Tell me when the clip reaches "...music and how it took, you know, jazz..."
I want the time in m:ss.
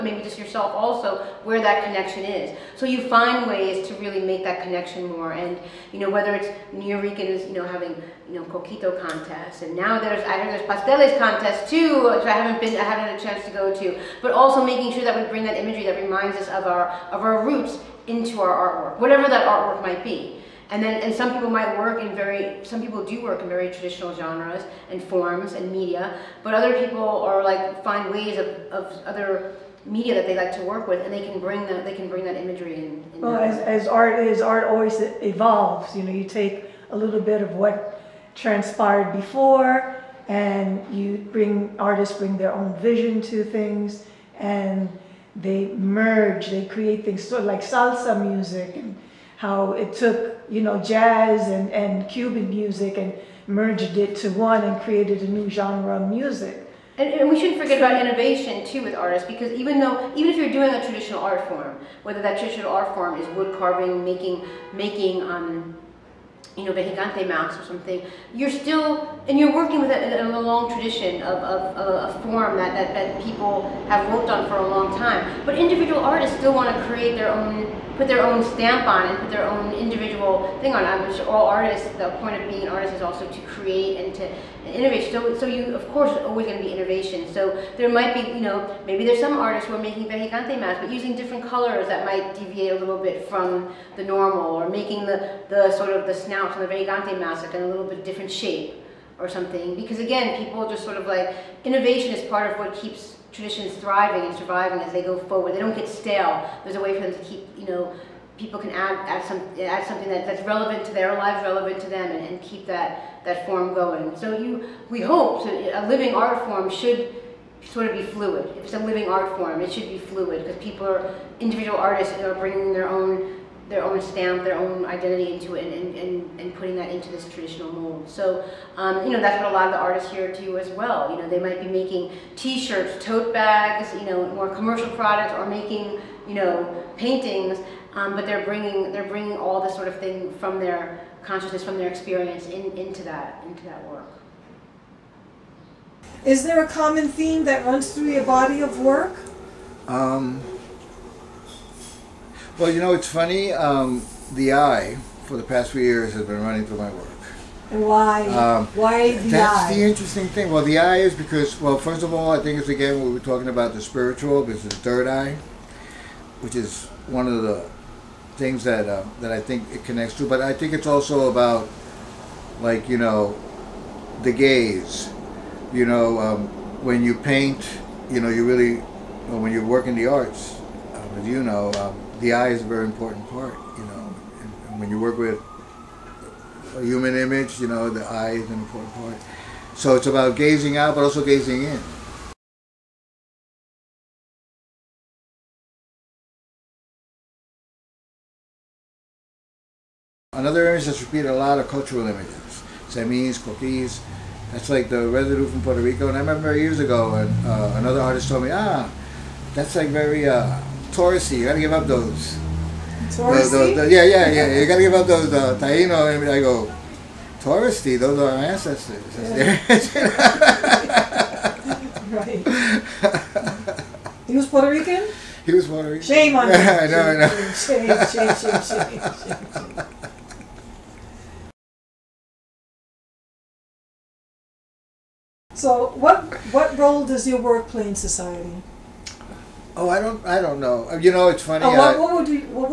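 0:48.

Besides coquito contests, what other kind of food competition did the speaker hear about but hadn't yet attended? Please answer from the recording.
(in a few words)
pasteles contests.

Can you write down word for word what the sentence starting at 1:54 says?
So you, we hope so a living art form should sort of be fluid.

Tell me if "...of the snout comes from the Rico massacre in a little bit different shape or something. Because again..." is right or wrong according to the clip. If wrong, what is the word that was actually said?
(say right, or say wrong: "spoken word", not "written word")
wrong: "Regante", not "Rico".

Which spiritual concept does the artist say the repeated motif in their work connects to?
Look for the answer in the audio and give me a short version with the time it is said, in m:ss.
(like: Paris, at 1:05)
the third eye, at 2:44.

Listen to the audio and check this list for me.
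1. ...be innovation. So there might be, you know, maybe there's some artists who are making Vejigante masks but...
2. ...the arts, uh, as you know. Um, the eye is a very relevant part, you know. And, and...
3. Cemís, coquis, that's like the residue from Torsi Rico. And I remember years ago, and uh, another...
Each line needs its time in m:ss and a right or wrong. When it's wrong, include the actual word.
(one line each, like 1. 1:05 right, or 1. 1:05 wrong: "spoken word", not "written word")
1. 1:26 right
2. 2:59 wrong: "important", not "relevant"
3. 3:22 wrong: "Puerto", not "Torsi".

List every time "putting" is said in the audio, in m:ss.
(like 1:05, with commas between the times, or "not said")
2:06.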